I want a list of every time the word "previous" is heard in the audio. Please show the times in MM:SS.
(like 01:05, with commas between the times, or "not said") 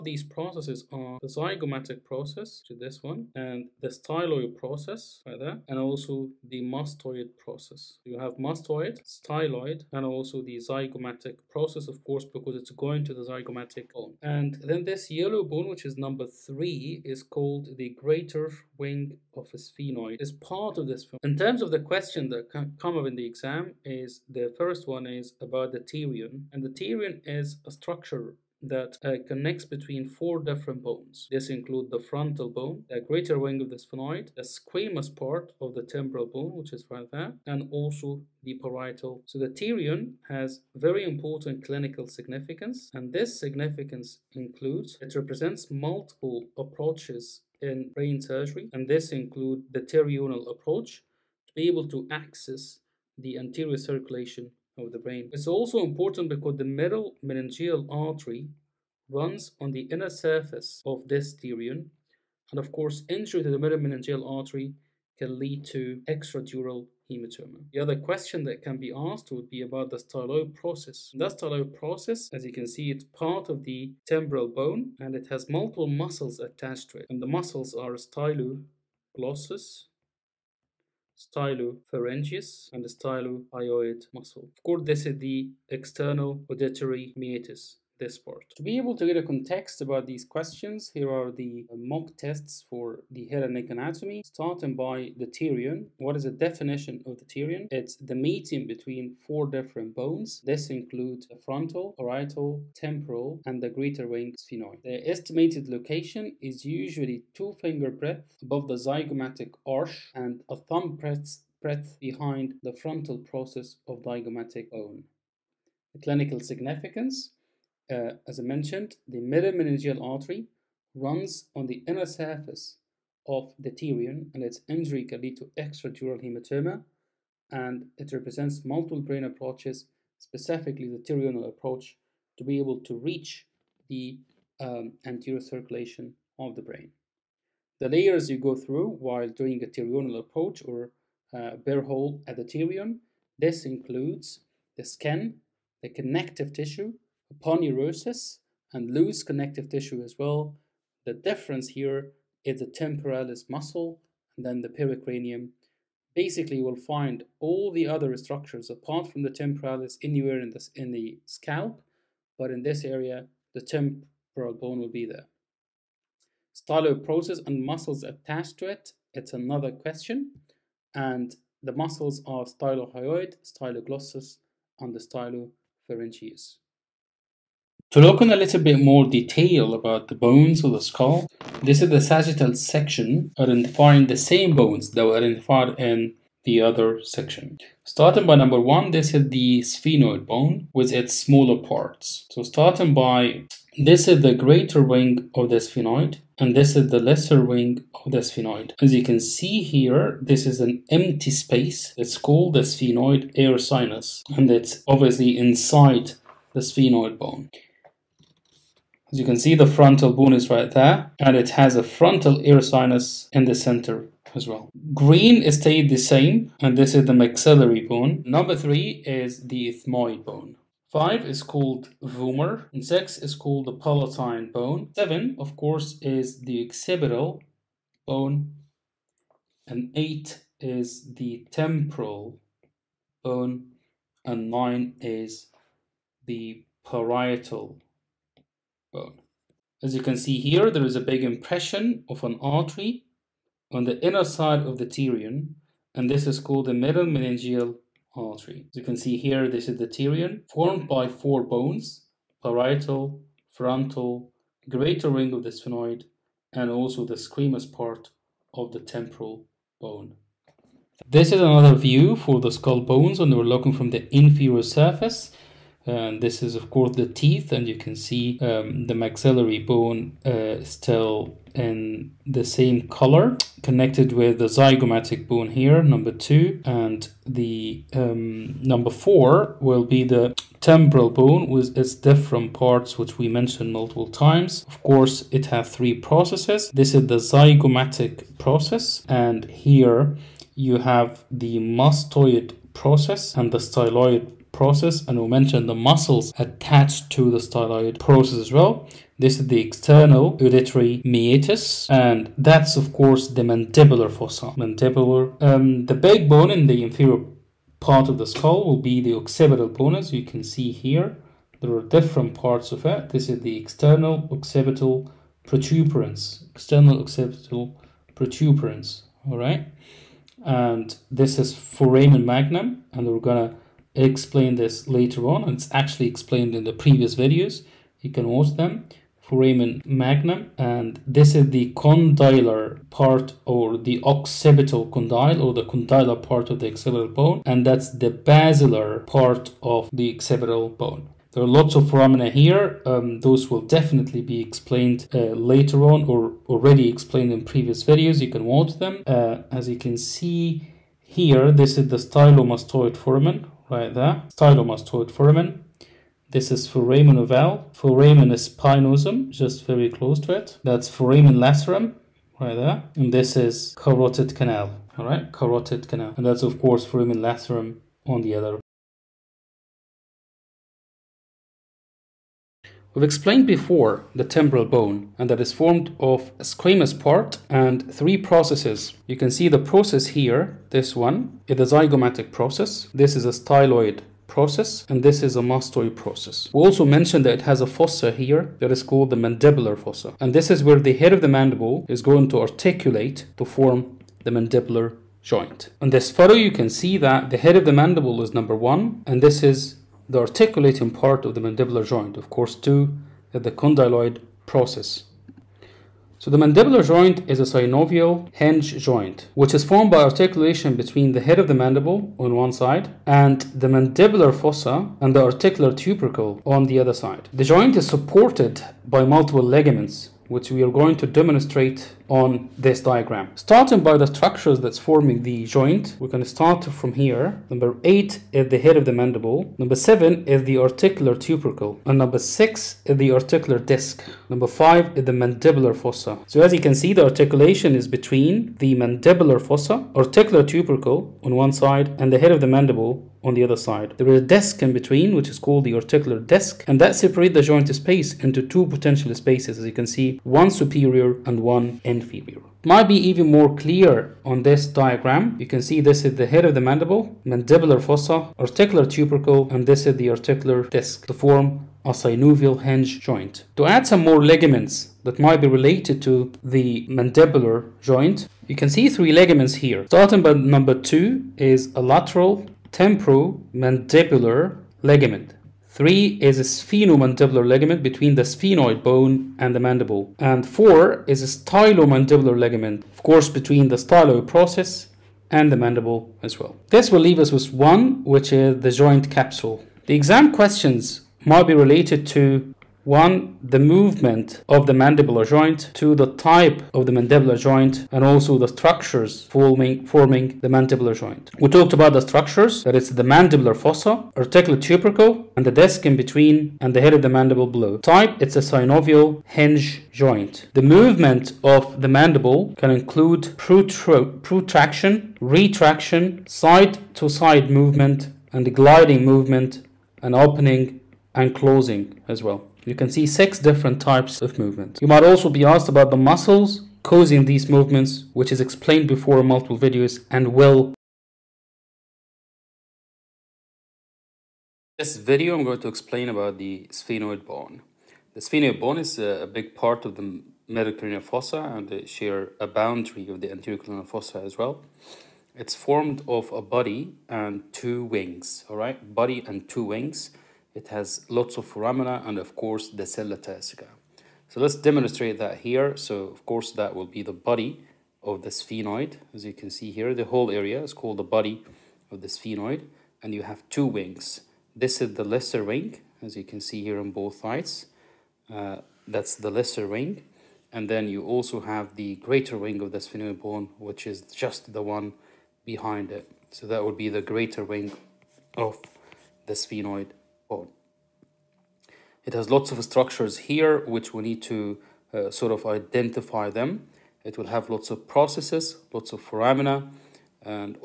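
05:26, 05:47.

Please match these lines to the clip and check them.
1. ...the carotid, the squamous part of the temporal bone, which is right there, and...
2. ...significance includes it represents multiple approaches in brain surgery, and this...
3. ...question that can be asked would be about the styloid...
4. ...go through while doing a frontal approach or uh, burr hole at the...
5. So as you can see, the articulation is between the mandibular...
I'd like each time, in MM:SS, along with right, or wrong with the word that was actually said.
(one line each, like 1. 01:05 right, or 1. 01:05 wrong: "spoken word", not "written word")
1. 00:33 wrong: "sphenoid", not "carotid"
2. 00:43 right
3. 01:07 right
4. 02:18 wrong: "pterional", not "frontal"
5. 07:16 right.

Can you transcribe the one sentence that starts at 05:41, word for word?
There are lots of foramina here.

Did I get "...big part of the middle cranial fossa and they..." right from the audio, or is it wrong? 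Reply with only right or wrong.
right.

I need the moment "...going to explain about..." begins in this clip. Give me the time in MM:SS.
08:55.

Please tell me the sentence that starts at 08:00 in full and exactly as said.
And four is a stylomandibular ligament, of course, between the process and the mandible as well.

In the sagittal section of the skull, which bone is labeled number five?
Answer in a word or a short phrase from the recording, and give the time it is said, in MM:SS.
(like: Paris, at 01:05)
Vomer, at 03:40.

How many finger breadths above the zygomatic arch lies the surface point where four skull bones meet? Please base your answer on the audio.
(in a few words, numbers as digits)
2.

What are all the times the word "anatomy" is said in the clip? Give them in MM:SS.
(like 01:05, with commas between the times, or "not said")
01:33.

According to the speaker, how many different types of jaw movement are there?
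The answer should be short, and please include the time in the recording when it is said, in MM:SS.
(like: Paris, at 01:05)
6, at 08:43.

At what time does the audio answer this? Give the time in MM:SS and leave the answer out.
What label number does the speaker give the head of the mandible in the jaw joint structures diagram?
07:07.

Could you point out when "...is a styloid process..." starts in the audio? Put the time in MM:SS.
06:23.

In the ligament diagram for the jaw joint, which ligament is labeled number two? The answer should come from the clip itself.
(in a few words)
Lateral temporomandibular ligament.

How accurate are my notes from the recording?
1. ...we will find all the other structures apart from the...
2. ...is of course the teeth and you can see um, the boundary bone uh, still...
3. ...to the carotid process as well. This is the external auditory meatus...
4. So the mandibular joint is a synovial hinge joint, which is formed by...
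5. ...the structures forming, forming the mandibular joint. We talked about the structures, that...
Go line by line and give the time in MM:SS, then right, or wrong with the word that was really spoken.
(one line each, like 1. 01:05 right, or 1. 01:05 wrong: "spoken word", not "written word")
1. 02:36 right
2. 04:26 wrong: "maxillary", not "boundary"
3. 04:57 wrong: "styloid", not "carotid"
4. 06:46 right
5. 08:18 right.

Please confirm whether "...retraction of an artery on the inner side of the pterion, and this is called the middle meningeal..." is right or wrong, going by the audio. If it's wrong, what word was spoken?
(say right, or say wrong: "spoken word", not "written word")
wrong: "impression", not "retraction".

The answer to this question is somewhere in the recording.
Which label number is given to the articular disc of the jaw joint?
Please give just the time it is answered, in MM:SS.
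07:11.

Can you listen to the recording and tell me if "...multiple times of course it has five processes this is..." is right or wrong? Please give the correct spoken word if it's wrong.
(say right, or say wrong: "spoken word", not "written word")
wrong: "three", not "five".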